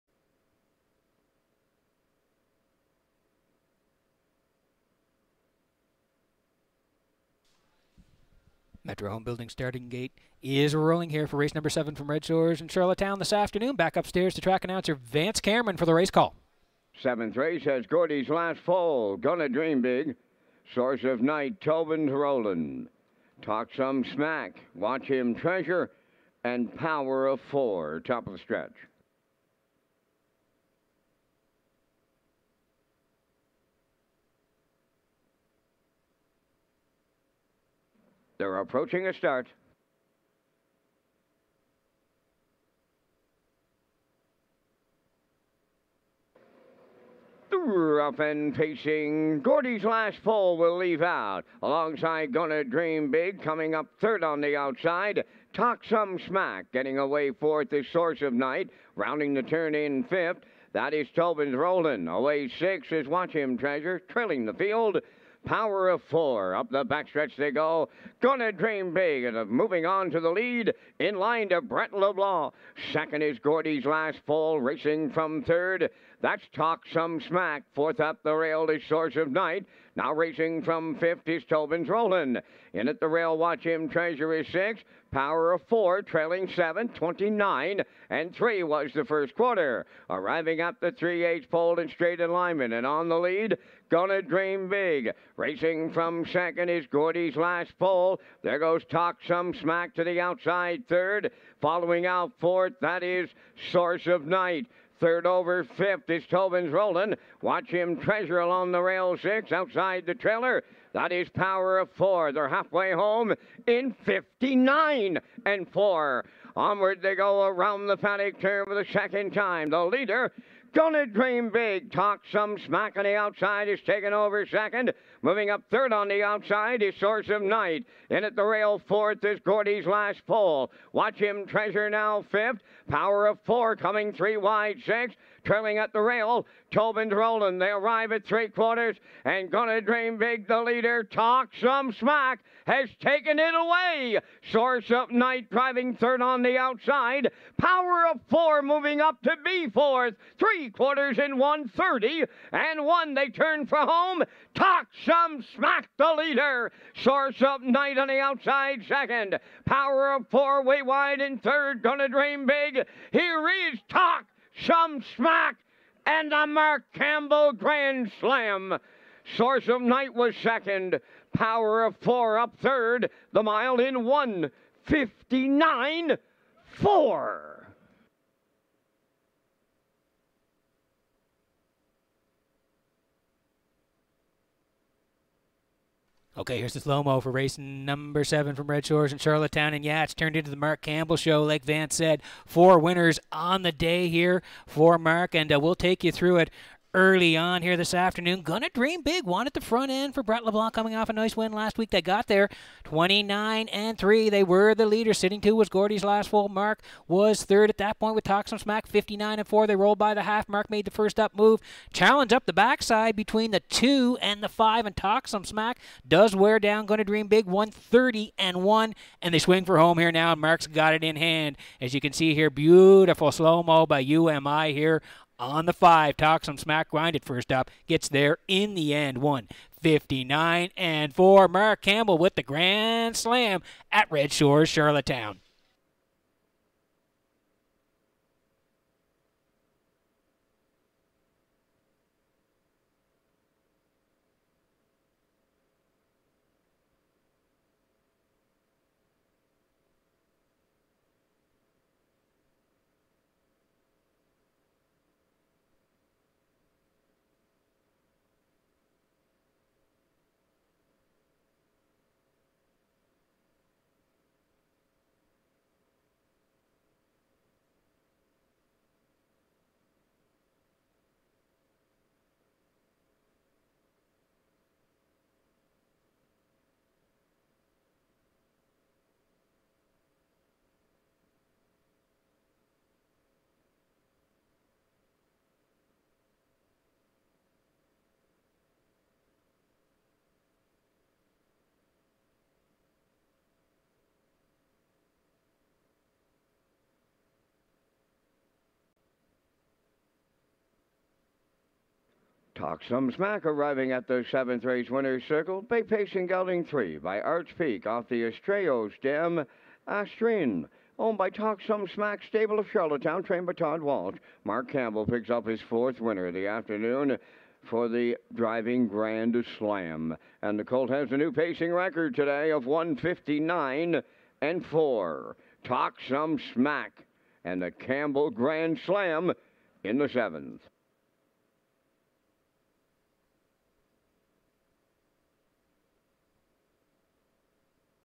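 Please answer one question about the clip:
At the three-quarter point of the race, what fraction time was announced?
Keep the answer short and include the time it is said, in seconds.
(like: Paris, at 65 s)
1:30.1, at 151 s.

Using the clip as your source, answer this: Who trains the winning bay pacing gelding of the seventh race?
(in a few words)
Todd Walsh.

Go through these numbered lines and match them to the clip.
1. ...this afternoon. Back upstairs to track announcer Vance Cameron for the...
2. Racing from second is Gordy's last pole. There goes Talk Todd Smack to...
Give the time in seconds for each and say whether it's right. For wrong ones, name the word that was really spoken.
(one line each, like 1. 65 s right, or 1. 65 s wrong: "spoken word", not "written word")
1. 13 s right
2. 95 s wrong: "Some", not "Todd".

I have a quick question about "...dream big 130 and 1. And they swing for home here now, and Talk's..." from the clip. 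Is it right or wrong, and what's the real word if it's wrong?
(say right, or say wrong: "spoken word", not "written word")
wrong: "Mark", not "Talk".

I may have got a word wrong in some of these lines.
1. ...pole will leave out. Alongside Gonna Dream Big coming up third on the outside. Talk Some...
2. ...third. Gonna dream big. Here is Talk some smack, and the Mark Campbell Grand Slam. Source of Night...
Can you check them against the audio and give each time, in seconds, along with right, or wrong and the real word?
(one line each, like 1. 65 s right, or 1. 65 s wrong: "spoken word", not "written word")
1. 50 s right
2. 161 s right.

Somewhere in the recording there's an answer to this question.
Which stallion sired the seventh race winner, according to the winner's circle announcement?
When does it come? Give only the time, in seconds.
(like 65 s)
307 s.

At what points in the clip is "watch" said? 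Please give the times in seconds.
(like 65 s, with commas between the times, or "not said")
24 s, 63 s, 83 s, 107 s, 130 s.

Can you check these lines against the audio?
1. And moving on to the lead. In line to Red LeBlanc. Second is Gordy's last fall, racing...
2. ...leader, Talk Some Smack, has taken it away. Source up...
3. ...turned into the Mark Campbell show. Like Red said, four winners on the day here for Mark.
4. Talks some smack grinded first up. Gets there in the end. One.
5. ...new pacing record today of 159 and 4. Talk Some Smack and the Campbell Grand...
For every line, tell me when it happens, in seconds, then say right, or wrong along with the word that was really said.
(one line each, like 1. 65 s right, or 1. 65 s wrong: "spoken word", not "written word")
1. 69 s wrong: "Brett", not "Red"
2. 140 s right
3. 190 s wrong: "Vance", not "Red"
4. 226 s right
5. 321 s right.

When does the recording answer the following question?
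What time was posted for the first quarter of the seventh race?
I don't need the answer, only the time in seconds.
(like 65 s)
86 s.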